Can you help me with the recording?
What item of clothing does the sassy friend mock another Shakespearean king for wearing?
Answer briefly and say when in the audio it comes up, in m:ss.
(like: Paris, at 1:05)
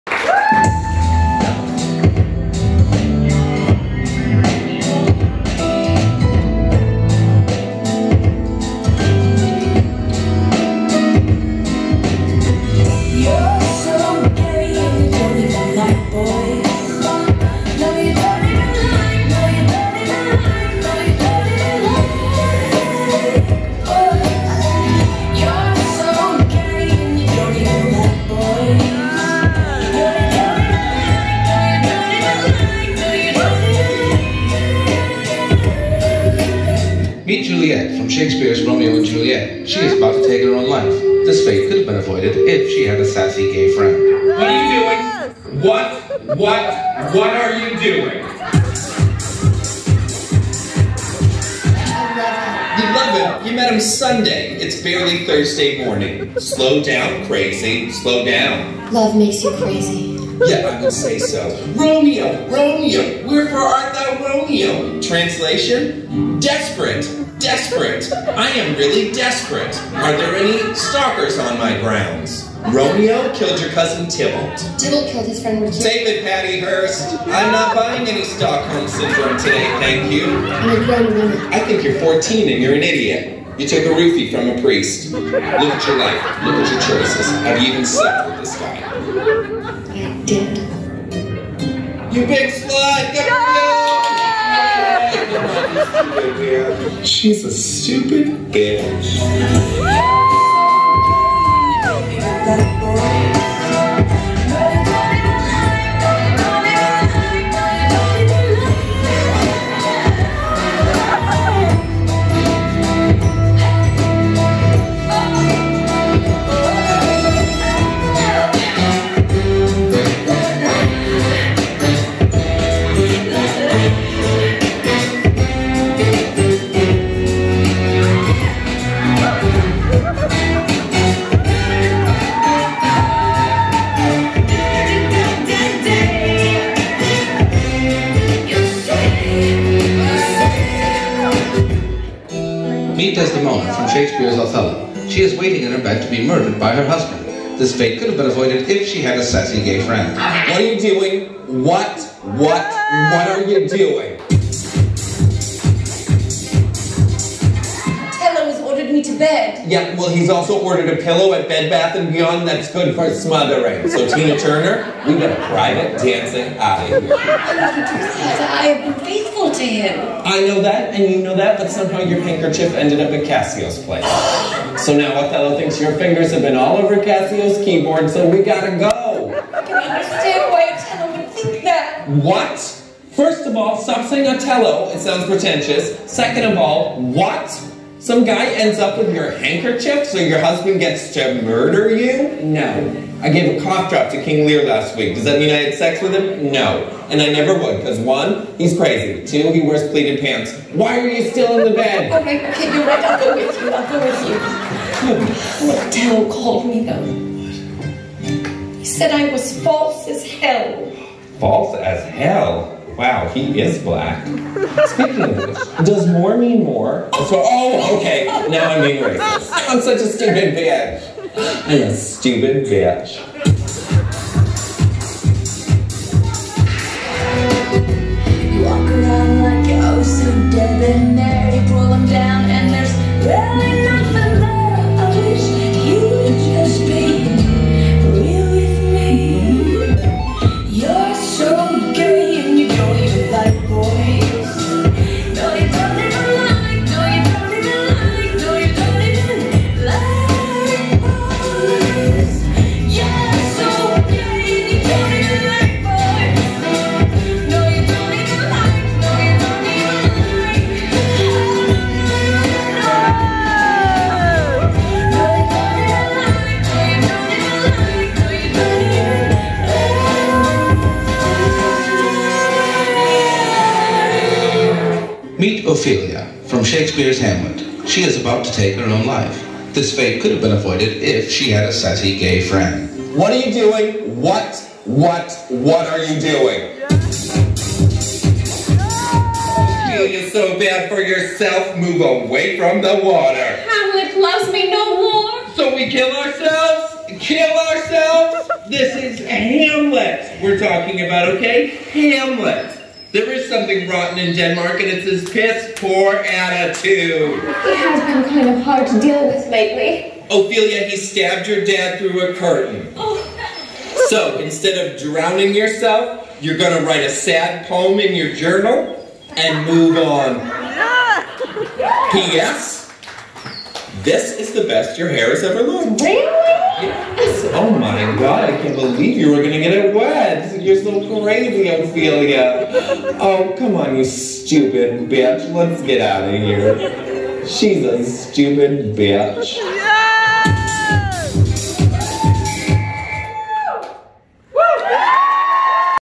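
Pleated pants, at 3:19.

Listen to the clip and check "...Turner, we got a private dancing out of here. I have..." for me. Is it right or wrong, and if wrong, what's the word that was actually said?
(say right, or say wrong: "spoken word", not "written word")
right.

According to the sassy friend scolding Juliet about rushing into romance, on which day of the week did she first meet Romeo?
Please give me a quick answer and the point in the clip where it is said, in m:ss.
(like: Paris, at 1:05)
Sunday, at 0:53.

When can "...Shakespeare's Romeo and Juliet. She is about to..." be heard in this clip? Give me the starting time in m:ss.
0:38.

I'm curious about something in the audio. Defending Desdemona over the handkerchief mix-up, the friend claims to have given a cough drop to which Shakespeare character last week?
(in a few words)
King Lear.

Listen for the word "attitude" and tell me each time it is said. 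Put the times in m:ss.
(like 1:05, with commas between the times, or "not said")
5:06.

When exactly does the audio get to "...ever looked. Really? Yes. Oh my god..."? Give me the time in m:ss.
5:25.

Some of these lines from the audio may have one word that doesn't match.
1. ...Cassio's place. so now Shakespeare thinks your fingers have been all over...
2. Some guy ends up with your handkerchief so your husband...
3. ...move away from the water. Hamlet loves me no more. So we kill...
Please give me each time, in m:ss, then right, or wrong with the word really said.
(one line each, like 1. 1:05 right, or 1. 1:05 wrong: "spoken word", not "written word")
1. 2:53 wrong: "Othello", not "Shakespeare"
2. 3:08 right
3. 4:51 right.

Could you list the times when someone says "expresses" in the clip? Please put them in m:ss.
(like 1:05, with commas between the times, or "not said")
not said.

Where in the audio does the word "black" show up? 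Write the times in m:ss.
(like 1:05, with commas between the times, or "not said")
3:33.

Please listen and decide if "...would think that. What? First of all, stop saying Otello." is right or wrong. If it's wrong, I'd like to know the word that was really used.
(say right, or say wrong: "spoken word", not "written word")
right.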